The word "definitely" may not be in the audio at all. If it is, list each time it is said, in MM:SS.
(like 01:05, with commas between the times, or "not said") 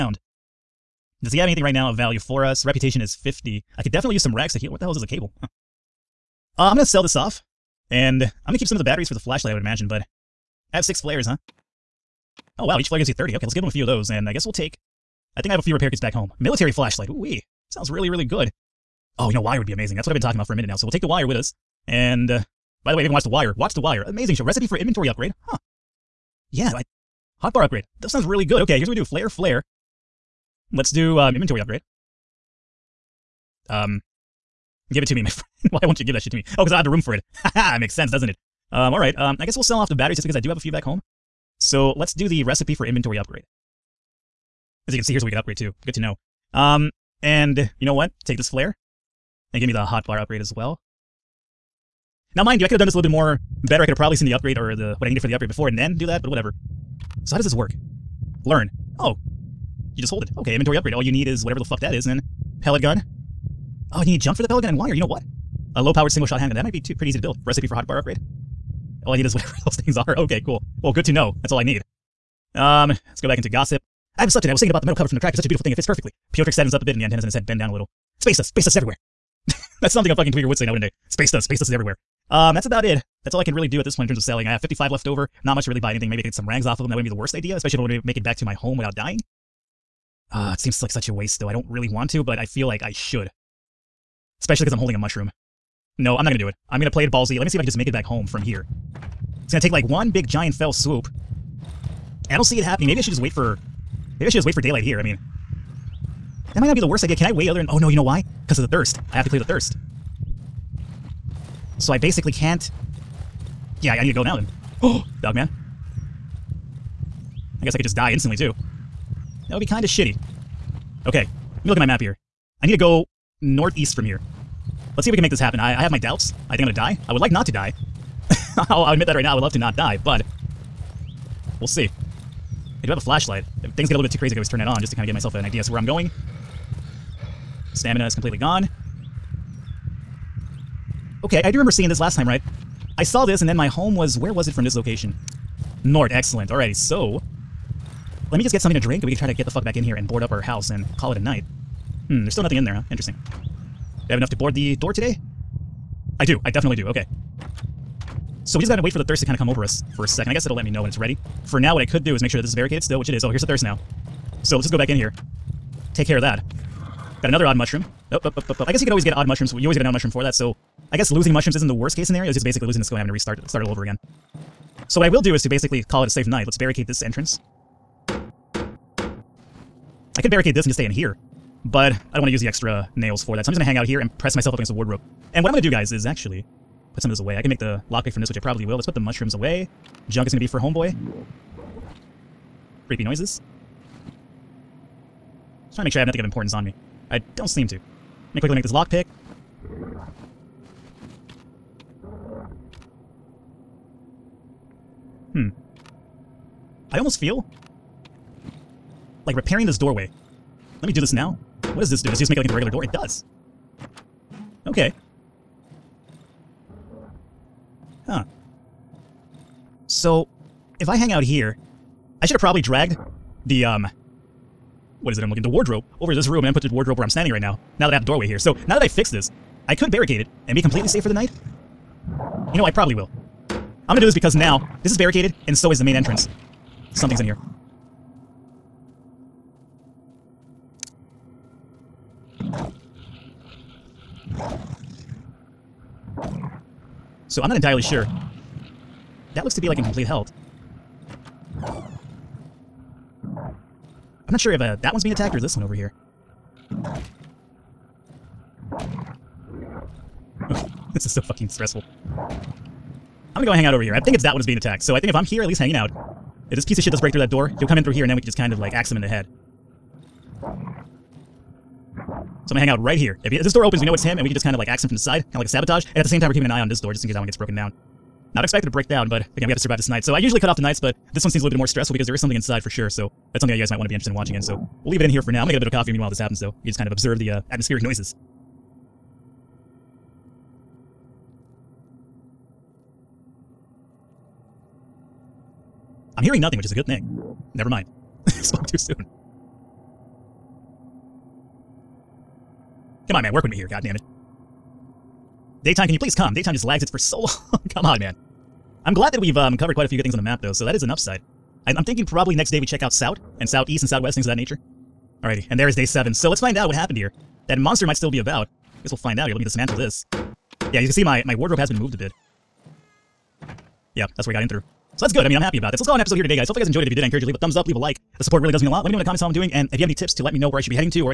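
00:03, 02:36.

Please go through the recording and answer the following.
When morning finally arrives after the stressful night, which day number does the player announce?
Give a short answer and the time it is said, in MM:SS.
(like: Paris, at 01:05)
7, at 05:15.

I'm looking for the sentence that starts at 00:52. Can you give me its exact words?
Now, mind you, I could have done this a little bit more better.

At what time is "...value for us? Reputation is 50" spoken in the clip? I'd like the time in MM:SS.
00:01.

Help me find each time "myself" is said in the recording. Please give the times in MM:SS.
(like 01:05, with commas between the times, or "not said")
02:15, 03:04.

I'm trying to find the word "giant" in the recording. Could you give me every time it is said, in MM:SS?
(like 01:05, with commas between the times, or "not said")
01:40.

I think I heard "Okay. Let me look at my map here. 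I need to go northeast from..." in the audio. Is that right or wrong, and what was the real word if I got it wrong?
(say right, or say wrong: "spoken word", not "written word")
right.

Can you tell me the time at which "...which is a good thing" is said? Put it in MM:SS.
04:56.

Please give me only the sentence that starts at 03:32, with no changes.
Does it just make it like into a regular door?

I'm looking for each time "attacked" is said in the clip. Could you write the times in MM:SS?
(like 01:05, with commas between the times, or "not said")
04:15, 04:24.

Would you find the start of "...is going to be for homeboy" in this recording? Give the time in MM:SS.
03:10.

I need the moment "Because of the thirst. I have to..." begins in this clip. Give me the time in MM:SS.
01:48.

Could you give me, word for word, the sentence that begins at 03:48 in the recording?
So now that I fixed this, I could barricade it and be completely safe for the night.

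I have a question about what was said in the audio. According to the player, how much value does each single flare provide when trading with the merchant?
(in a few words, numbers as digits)
30.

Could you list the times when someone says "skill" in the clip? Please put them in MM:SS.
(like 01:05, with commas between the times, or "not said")
02:52.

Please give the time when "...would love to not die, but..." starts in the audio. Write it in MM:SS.
02:09.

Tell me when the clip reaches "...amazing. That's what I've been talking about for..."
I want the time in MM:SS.
00:19.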